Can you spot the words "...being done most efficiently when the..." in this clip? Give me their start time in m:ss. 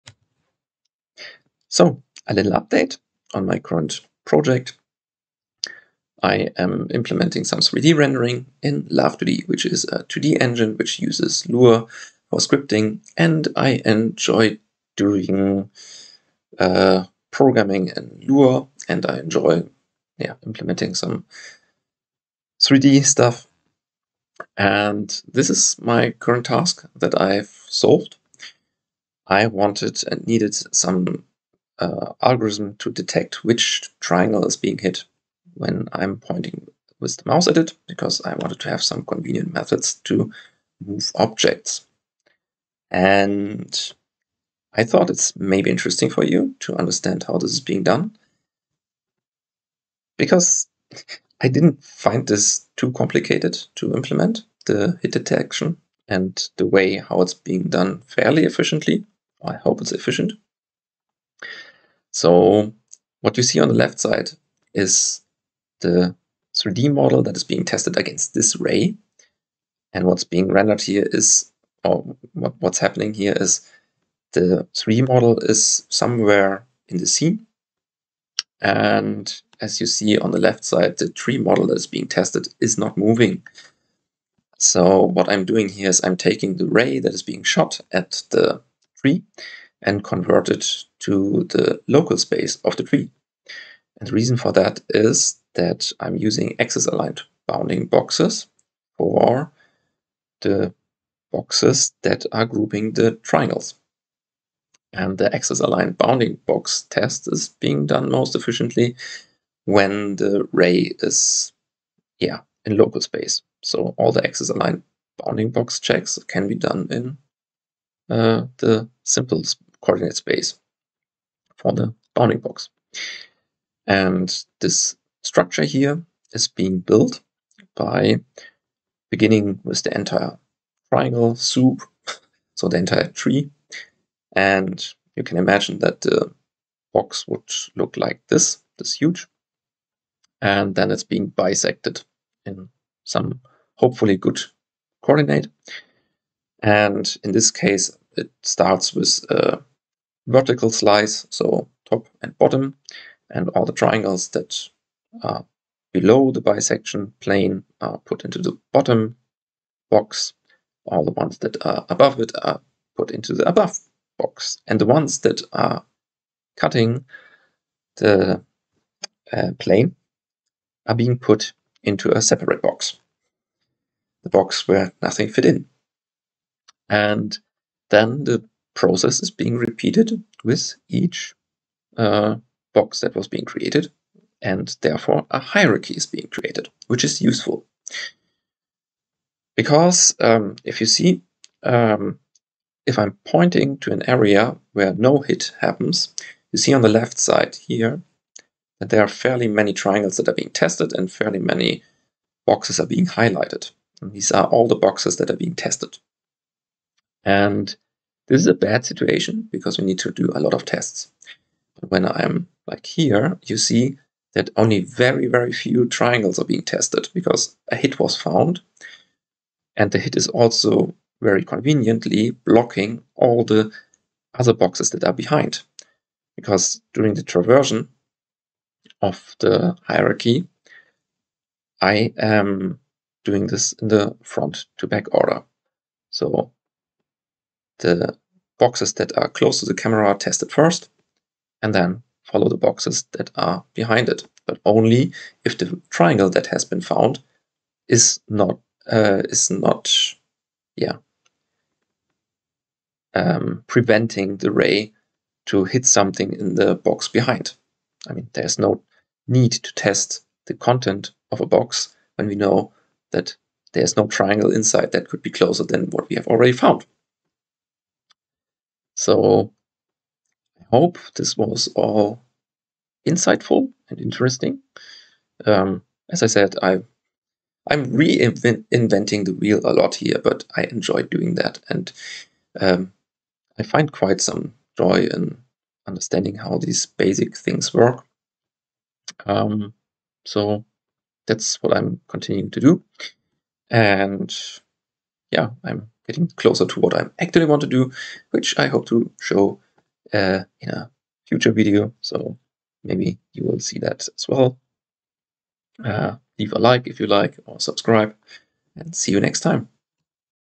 1:47.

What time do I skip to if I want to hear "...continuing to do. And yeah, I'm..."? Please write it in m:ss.
4:52.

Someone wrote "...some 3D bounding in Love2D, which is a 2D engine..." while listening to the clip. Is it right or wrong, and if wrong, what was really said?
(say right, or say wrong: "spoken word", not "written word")
wrong: "rendering", not "bounding".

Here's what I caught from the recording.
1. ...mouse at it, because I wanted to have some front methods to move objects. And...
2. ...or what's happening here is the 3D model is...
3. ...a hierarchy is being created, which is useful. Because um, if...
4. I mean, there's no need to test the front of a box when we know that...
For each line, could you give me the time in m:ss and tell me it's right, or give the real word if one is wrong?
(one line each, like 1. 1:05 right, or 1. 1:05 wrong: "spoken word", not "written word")
1. 0:37 wrong: "convenient", not "front"
2. 1:11 right
3. 3:05 right
4. 4:18 wrong: "content", not "front".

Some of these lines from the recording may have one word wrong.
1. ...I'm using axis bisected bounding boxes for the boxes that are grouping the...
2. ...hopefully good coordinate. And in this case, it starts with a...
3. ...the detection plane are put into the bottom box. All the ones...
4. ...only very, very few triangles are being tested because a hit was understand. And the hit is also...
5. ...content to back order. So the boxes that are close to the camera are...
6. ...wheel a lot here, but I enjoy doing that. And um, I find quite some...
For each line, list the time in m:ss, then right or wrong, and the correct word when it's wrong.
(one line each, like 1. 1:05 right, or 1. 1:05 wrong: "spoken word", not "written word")
1. 1:35 wrong: "aligned", not "bisected"
2. 2:23 right
3. 2:36 wrong: "bisection", not "detection"
4. 3:34 wrong: "found", not "understand"
5. 3:54 wrong: "front", not "content"
6. 4:39 right.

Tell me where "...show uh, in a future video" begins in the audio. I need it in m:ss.
4:59.